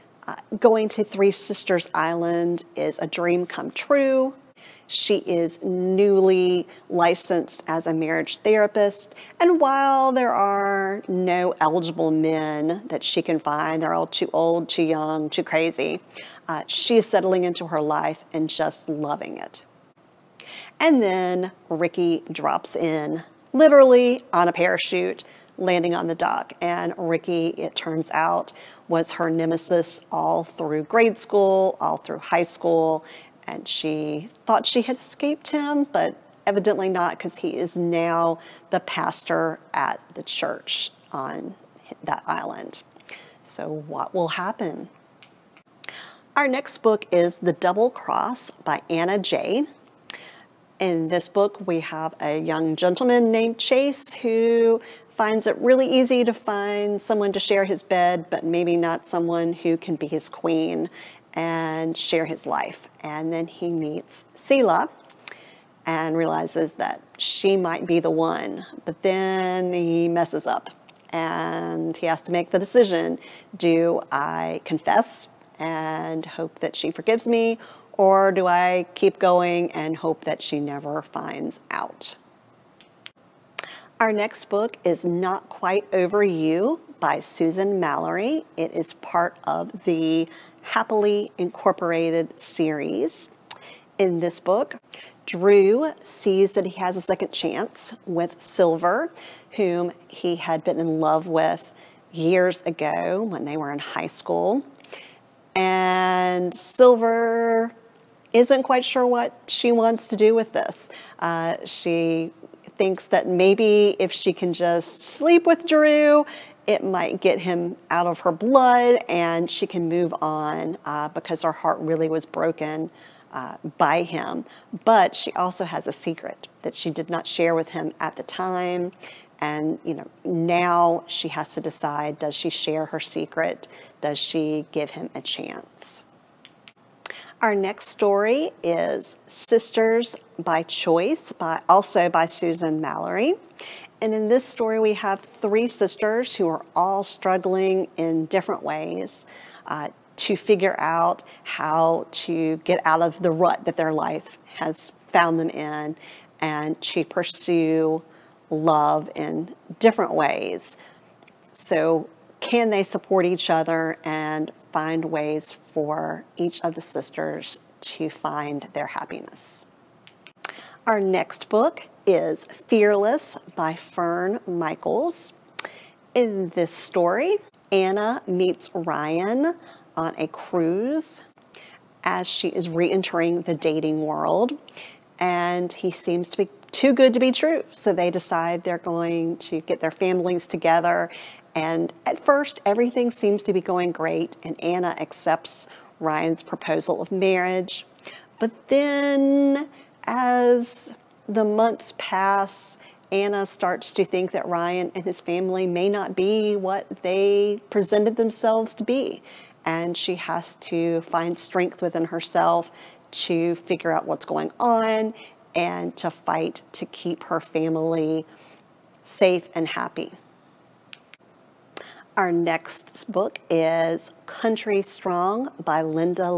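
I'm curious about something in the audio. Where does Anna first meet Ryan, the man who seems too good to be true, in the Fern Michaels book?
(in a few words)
On a cruise.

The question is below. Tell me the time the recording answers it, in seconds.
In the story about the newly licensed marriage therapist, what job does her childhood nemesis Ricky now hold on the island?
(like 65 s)
38 s.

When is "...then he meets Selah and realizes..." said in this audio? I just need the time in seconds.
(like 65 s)
63 s.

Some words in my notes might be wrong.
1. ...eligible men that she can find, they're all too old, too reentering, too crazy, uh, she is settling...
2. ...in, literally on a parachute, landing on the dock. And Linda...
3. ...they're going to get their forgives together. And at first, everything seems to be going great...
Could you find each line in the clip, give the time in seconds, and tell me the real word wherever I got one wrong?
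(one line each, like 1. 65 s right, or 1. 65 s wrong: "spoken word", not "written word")
1. 11 s wrong: "young", not "reentering"
2. 22 s wrong: "Ricky", not "Linda"
3. 188 s wrong: "families", not "forgives".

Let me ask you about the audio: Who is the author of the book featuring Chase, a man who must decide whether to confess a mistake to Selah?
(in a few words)
Anna J.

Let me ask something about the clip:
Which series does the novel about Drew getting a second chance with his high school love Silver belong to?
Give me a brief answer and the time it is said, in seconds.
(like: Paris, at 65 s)
Happily Incorporated, at 90 s.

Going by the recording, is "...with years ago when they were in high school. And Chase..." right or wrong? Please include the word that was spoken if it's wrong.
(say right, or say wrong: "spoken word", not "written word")
wrong: "Silver", not "Chase".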